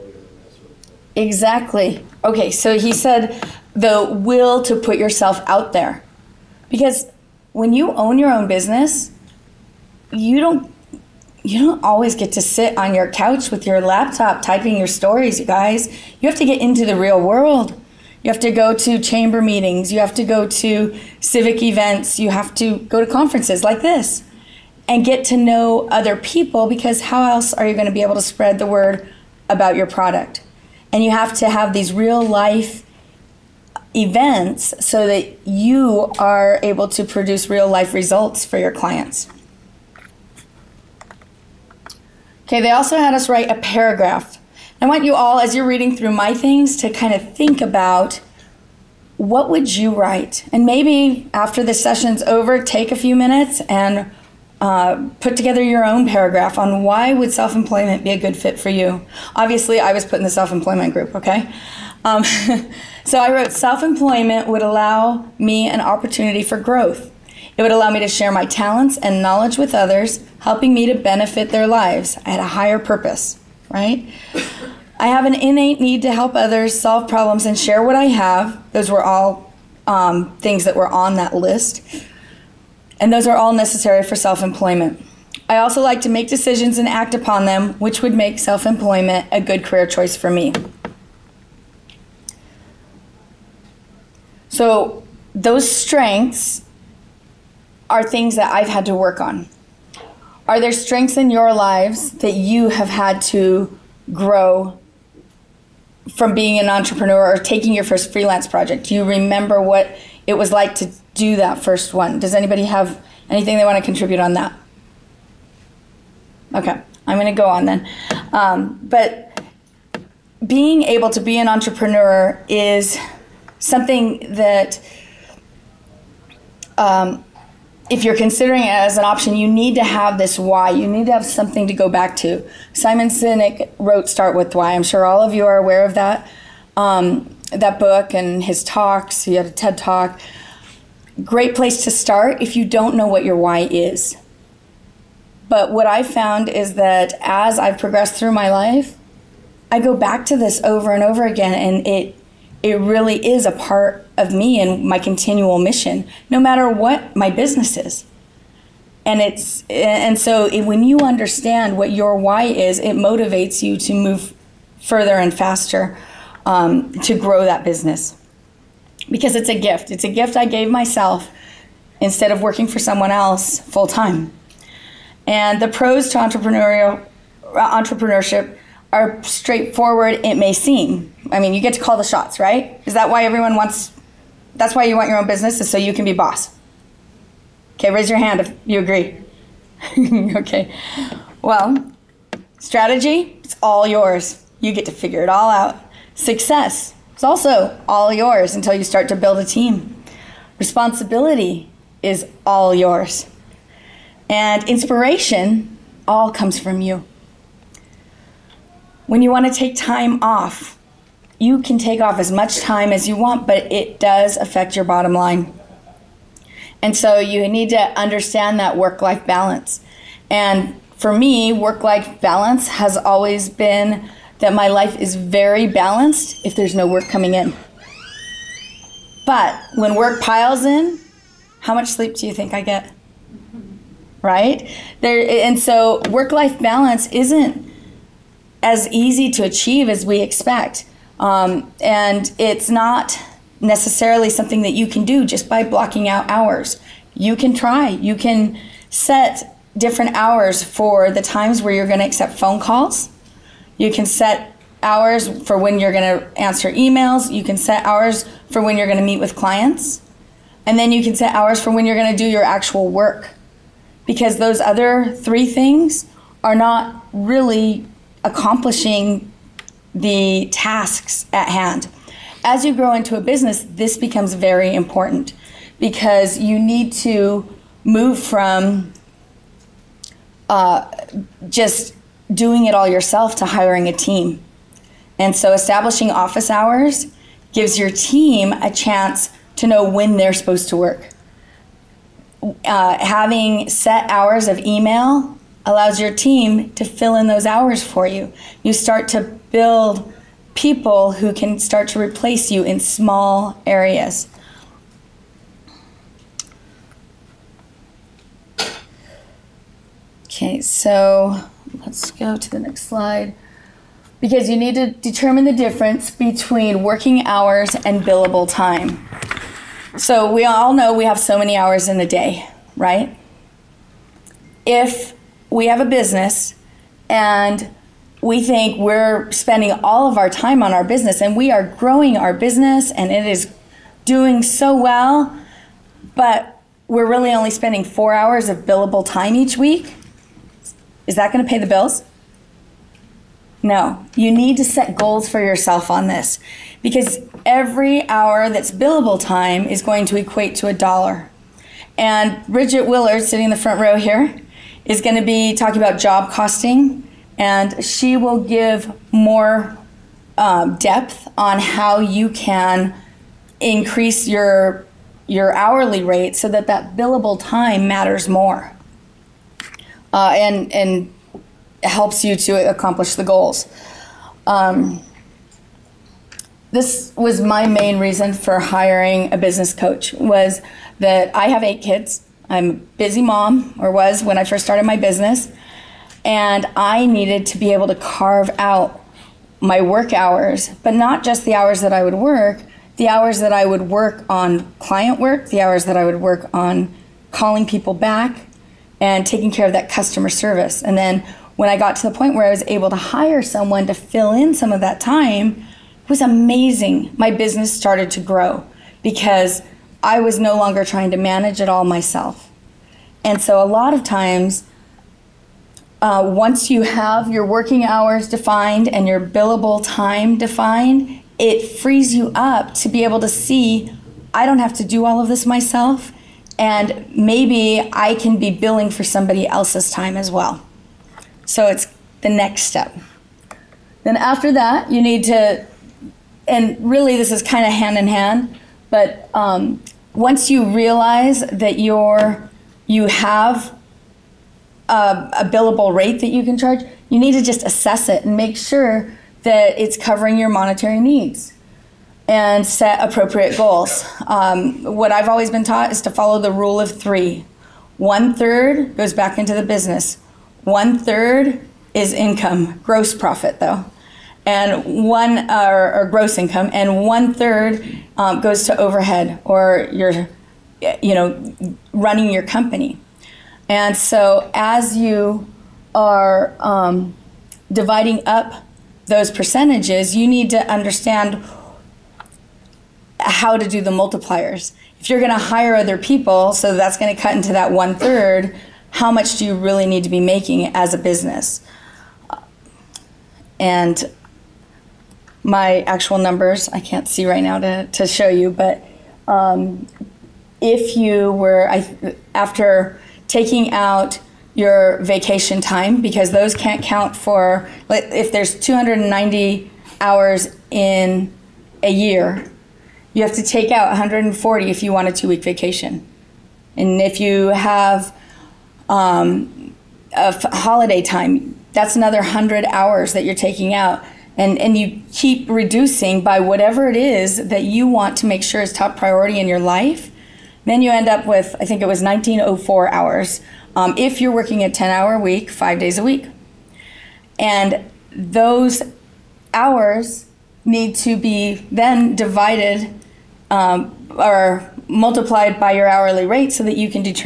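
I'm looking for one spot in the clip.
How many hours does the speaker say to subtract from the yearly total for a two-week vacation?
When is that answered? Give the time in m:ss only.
8:33.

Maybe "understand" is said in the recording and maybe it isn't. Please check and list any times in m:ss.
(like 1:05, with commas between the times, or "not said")
2:40, 3:37, 8:00.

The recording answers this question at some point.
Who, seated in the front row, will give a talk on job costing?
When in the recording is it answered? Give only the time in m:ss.
5:52.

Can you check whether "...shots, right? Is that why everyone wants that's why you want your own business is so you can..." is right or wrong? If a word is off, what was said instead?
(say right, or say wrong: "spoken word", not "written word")
right.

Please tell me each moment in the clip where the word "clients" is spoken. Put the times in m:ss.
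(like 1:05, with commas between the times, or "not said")
0:38, 4:19, 6:34.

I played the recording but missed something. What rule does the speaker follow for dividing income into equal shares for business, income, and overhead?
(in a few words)
Rule of three.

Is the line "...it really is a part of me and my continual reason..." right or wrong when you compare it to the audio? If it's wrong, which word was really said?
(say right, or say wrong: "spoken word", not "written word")
wrong: "mission", not "reason".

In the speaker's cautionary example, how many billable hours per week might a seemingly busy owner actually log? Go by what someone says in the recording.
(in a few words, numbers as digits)
4.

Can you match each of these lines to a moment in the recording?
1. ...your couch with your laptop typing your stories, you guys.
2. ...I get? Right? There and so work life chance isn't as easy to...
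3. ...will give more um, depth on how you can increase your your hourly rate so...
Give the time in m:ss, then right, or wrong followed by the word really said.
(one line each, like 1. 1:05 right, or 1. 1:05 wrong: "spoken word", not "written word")
1. 0:12 right
2. 3:52 wrong: "balance", not "chance"
3. 5:58 right.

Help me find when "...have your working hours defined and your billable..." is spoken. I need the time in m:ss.
6:56.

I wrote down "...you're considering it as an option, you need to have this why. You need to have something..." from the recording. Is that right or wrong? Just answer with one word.
right.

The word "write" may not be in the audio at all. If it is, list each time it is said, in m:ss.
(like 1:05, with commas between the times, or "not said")
0:43, 0:49.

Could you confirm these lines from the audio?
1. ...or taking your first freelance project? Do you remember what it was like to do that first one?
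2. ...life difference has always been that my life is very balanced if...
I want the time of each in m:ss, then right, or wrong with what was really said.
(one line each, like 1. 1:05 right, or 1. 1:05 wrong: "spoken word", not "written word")
1. 1:47 right
2. 3:41 wrong: "balance", not "difference".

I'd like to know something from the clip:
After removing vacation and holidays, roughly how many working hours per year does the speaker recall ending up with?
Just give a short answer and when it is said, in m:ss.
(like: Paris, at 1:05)
1904, at 8:52.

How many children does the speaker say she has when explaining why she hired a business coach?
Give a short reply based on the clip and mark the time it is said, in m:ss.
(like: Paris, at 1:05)
8, at 6:21.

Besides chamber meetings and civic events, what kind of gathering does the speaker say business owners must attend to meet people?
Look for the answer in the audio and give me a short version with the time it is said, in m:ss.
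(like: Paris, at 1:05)
Conferences, at 0:23.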